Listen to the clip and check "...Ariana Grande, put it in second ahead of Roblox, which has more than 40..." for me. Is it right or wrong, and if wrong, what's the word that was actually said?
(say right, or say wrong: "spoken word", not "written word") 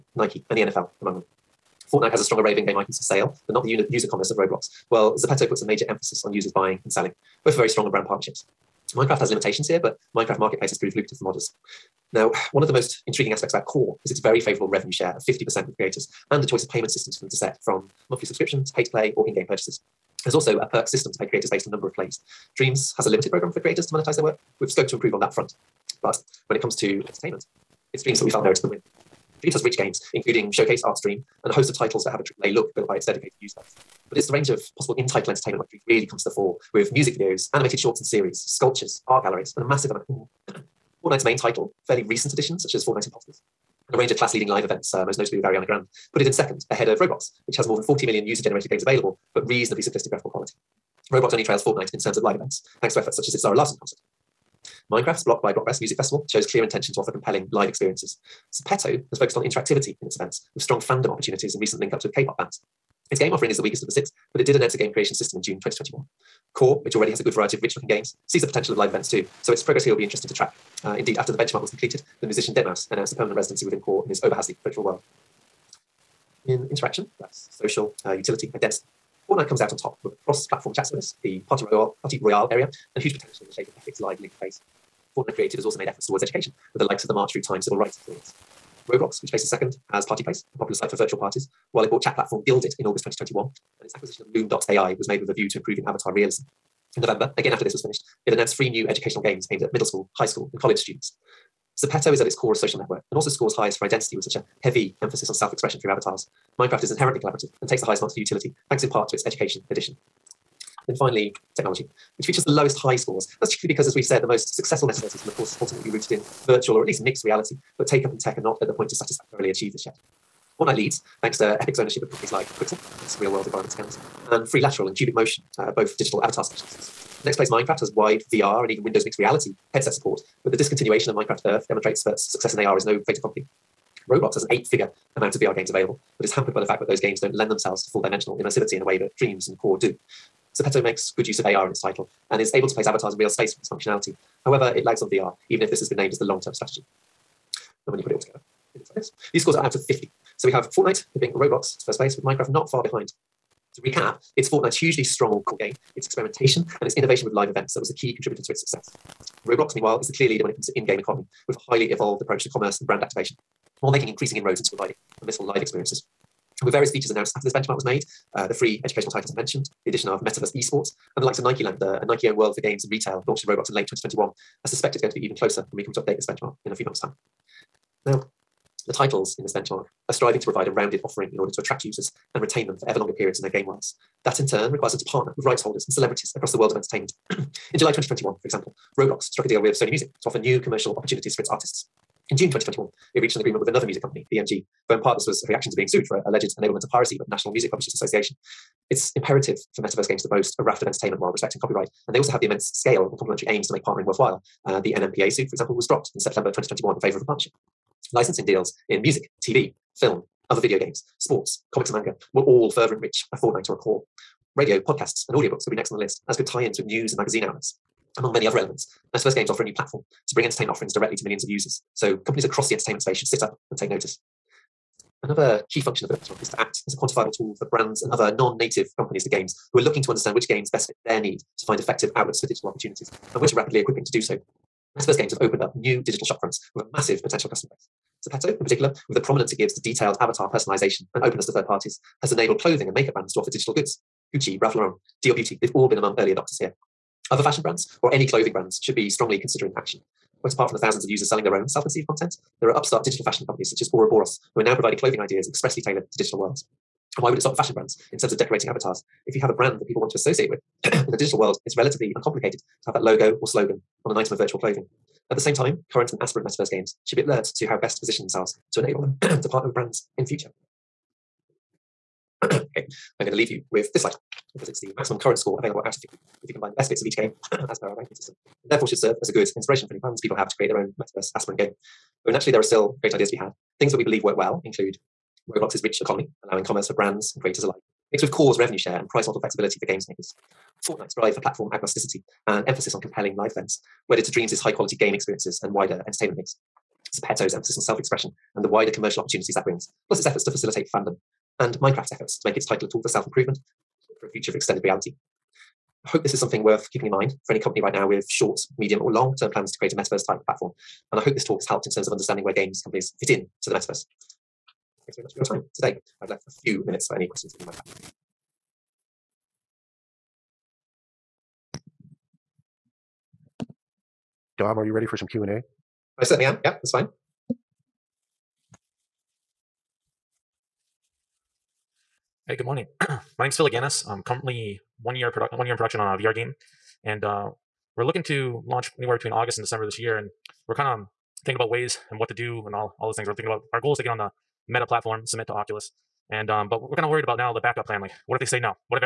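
right.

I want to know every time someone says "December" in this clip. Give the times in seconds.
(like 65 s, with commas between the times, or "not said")
339 s.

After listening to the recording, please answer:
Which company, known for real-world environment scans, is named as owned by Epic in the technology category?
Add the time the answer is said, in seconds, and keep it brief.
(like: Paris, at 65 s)
Quixel, at 122 s.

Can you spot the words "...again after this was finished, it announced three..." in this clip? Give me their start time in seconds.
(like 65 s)
97 s.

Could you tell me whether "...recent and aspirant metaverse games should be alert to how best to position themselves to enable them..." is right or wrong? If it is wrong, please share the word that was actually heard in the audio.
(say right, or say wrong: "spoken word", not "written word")
wrong: "current", not "recent".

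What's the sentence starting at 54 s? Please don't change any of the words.
Minecraft's Block by Blockwest Music Festival shows clear intention to offer compelling live experiences.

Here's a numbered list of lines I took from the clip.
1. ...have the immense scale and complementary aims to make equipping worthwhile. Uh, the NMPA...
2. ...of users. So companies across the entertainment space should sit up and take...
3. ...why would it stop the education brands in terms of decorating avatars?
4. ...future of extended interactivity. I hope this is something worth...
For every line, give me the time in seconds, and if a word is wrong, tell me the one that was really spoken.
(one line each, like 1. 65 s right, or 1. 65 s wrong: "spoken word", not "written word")
1. 202 s wrong: "partnering", not "equipping"
2. 221 s right
3. 257 s wrong: "fashion", not "education"
4. 304 s wrong: "reality", not "interactivity".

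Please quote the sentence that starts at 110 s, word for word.
Then finally, technology, which features the lowest high scores.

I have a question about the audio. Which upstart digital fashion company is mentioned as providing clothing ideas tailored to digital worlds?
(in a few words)
Bora Boros.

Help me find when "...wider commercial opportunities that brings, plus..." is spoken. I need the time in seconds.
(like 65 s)
298 s.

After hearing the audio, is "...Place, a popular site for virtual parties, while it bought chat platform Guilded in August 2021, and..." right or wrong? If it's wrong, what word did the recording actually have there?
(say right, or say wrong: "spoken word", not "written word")
right.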